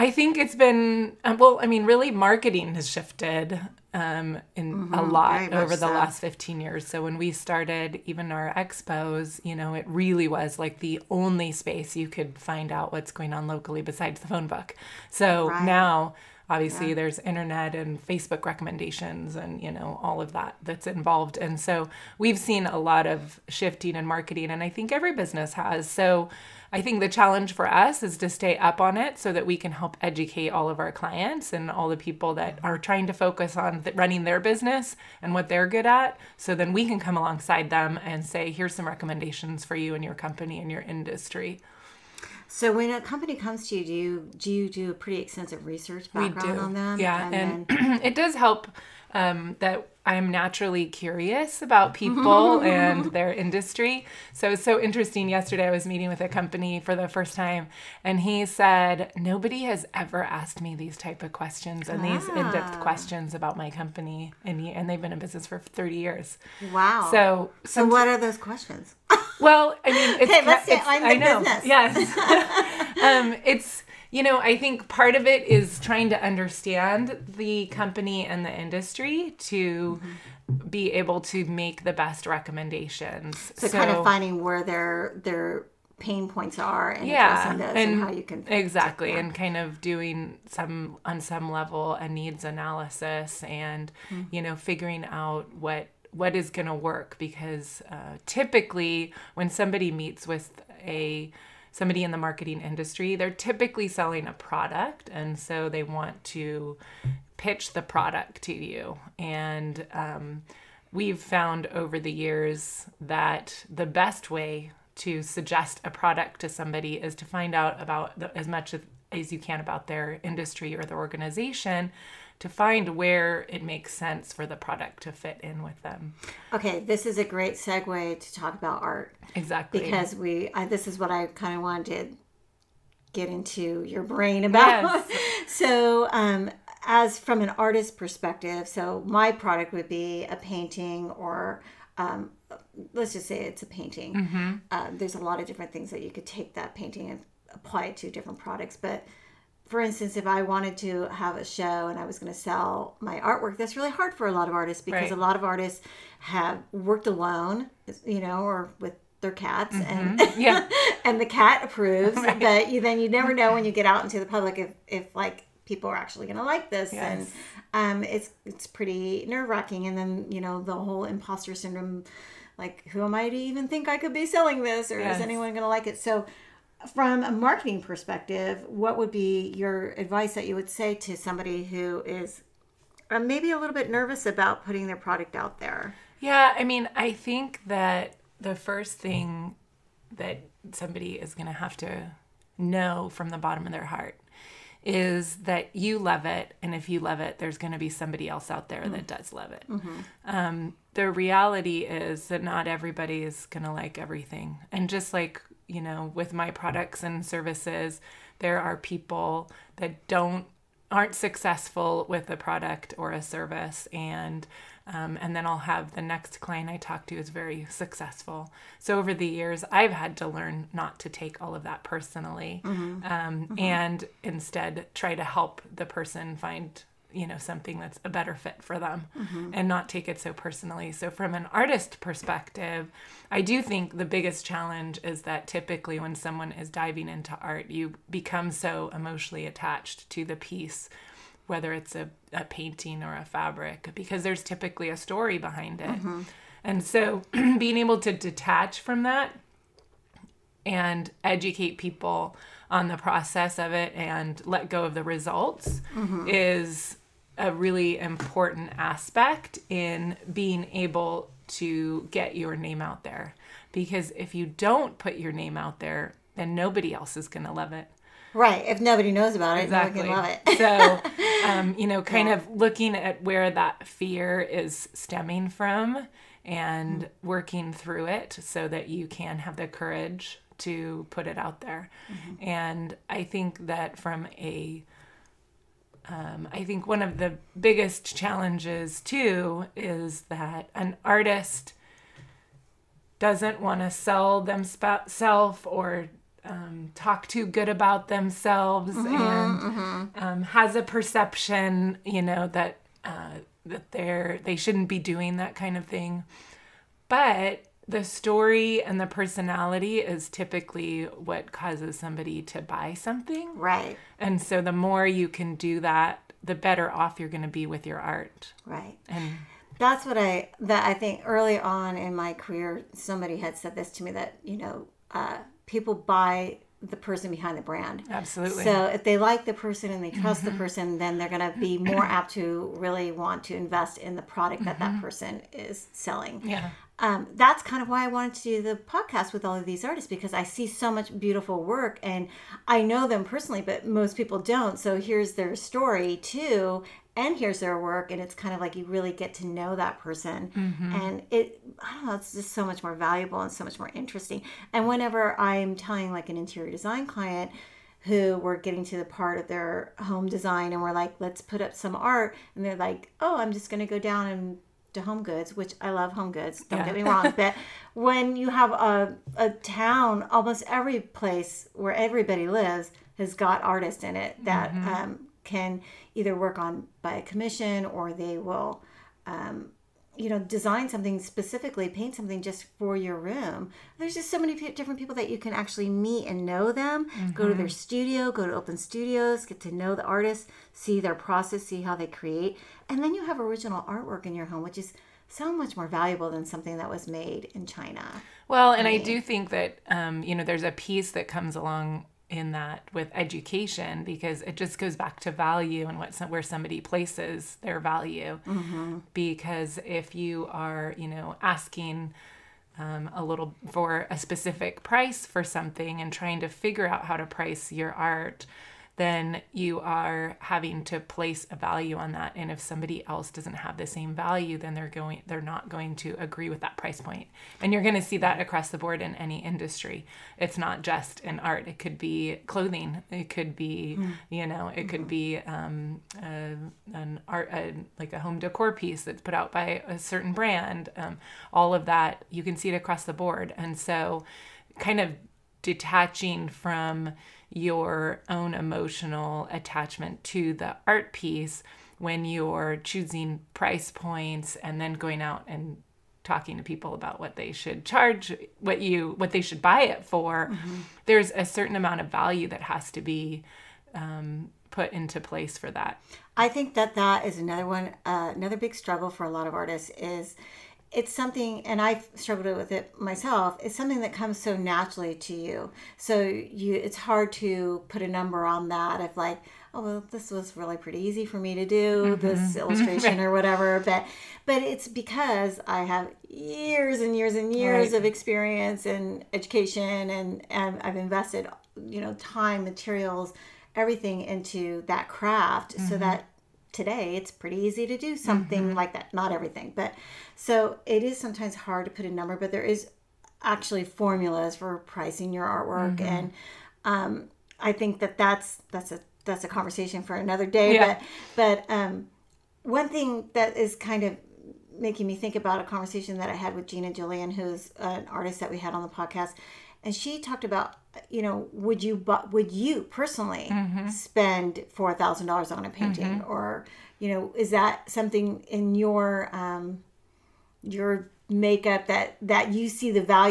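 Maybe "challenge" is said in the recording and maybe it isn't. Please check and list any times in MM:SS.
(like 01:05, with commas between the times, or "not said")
00:27, 03:54, 04:48.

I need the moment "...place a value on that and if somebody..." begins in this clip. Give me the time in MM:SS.
07:00.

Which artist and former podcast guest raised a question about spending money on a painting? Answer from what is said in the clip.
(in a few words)
Gina Julian.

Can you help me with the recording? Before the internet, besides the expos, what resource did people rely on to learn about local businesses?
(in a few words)
phone book.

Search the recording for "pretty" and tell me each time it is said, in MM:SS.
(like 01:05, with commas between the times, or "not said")
00:44, 02:48, 08:00, 08:17.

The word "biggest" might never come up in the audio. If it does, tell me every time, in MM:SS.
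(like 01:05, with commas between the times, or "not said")
03:54, 04:47.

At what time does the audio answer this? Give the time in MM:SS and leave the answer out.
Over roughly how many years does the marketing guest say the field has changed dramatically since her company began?
00:06.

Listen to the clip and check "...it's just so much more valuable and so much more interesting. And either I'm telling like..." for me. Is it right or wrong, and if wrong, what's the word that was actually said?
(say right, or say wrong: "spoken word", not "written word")
wrong: "whenever", not "either".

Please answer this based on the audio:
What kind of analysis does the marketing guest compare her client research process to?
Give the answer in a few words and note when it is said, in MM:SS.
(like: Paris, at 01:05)
needs analysis, at 01:32.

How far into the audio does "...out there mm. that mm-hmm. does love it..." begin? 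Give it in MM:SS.
03:18.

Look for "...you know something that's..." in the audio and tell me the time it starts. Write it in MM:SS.
03:47.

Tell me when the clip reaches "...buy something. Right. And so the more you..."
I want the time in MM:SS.
05:12.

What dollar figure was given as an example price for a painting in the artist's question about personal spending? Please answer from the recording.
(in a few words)
$4,000.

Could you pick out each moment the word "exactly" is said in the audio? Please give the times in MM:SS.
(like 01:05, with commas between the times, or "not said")
01:28, 02:09, 04:29.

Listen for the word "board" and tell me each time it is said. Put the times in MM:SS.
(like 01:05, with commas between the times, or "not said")
07:08, 07:23.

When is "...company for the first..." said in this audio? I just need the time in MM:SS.
00:56.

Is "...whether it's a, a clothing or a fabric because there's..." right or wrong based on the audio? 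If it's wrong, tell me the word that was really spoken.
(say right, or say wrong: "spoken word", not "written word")
wrong: "painting", not "clothing".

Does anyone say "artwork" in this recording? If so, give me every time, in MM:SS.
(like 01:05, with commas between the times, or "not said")
02:33, 06:33, 08:25.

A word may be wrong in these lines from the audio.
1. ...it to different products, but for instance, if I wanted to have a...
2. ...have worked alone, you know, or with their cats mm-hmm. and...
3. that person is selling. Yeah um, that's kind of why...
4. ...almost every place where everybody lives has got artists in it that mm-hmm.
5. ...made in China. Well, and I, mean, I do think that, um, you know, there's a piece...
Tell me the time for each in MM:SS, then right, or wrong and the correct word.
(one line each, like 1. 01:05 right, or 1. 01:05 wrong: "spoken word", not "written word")
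1. 02:27 right
2. 02:36 right
3. 05:34 right
4. 06:10 right
5. 06:37 right.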